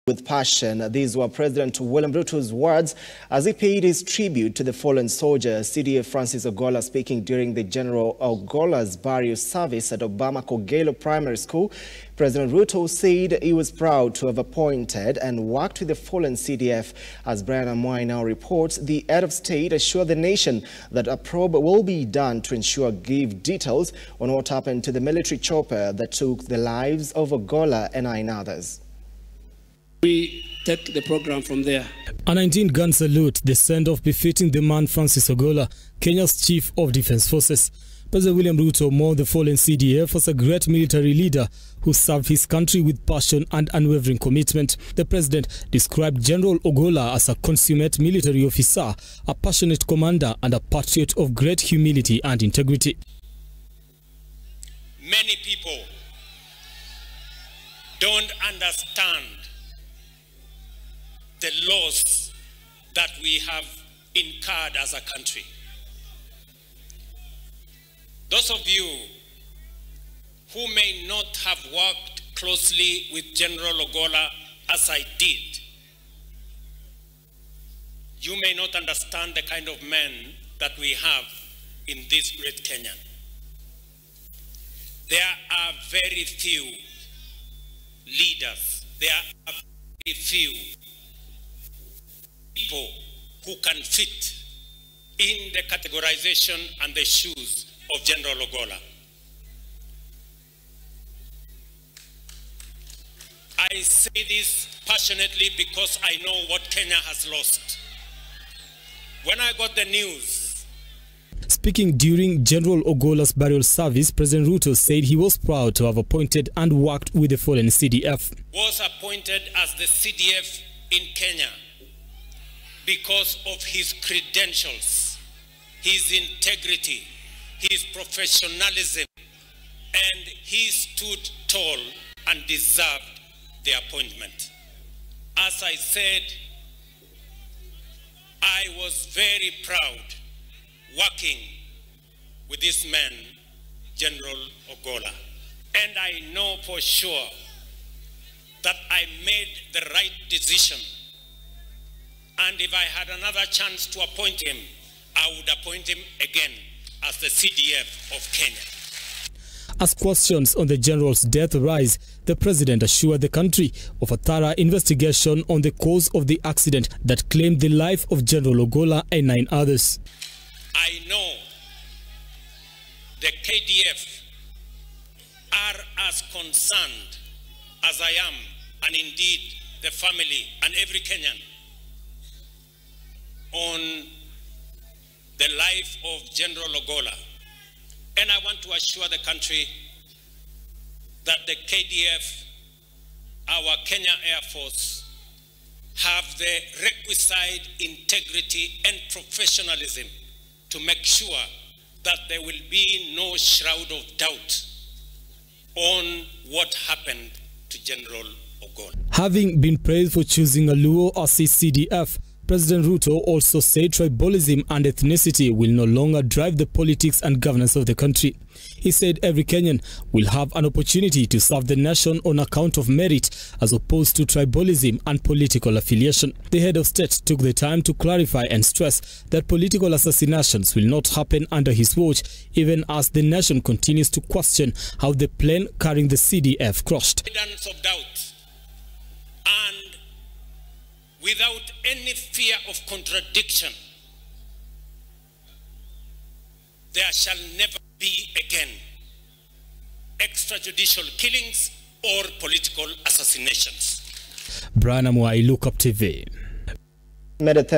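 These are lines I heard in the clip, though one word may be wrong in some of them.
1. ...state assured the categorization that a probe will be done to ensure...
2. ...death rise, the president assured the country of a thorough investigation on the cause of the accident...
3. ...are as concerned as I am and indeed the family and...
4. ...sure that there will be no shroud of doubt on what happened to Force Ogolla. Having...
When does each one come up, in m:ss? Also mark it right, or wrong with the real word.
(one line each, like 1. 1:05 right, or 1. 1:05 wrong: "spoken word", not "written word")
1. 0:19 wrong: "nation", not "categorization"
2. 2:41 right
3. 2:55 right
4. 3:21 wrong: "General", not "Force".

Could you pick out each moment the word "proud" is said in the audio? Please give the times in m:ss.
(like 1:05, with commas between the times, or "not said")
0:13, 1:55, 2:19.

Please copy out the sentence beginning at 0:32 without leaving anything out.
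A 19-gun salute, the send-off befitting the man Francis Ogolla, Kenya's chief of defense forces.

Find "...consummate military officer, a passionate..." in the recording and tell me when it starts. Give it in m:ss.
0:47.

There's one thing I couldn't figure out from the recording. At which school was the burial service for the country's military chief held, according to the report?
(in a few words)
Obama Kogelo Primary School.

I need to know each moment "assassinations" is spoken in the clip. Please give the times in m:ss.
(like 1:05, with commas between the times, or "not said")
3:49, 4:13.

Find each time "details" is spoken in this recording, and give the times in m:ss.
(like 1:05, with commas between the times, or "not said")
0:23.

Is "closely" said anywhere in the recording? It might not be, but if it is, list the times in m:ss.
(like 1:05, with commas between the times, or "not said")
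1:12.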